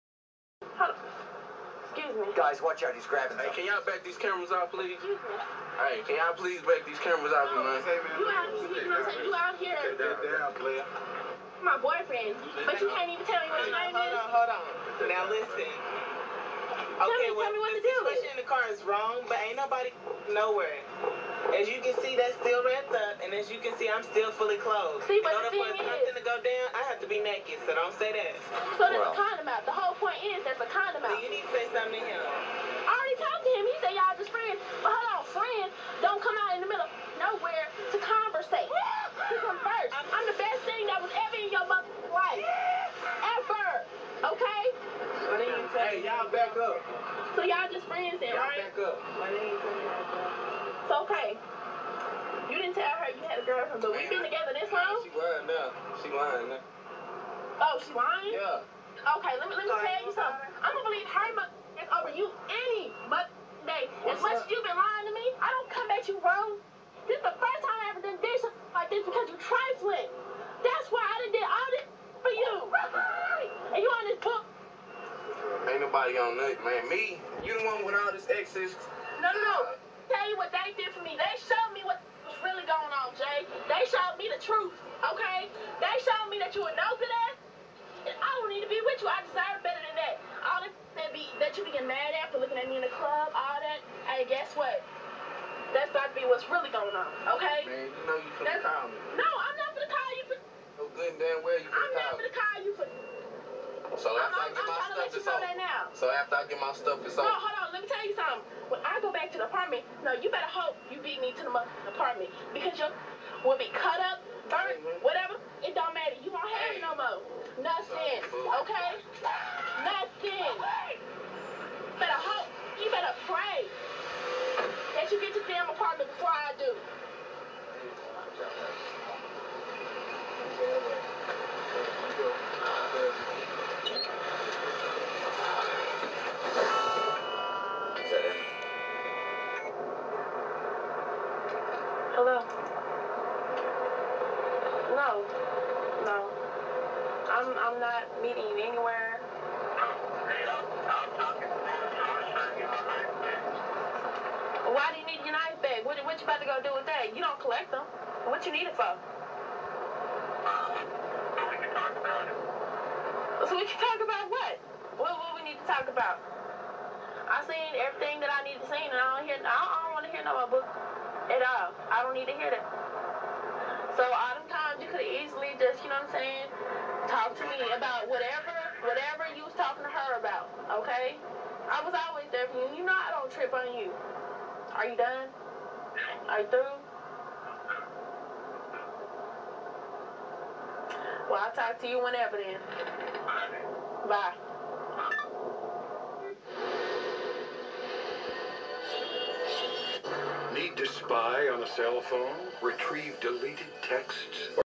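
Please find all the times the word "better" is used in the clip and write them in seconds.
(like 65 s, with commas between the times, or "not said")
89 s, 110 s.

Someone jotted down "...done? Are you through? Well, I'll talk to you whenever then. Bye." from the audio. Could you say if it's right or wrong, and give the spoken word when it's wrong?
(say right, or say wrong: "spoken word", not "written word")
right.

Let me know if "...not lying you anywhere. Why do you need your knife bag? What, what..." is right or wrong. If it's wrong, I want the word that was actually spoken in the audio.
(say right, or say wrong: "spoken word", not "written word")
wrong: "meeting", not "lying".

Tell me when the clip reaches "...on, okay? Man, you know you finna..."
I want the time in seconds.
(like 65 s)
96 s.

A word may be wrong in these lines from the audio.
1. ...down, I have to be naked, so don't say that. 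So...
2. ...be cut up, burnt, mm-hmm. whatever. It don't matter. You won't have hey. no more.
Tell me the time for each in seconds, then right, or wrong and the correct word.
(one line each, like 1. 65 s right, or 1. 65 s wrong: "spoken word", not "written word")
1. 26 s right
2. 113 s right.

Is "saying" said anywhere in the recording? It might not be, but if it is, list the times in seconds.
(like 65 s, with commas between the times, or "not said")
9 s, 176 s.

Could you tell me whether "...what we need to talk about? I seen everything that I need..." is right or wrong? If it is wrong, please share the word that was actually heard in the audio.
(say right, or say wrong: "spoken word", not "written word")
right.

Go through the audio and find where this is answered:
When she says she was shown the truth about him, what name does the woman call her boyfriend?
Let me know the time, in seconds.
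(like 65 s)
83 s.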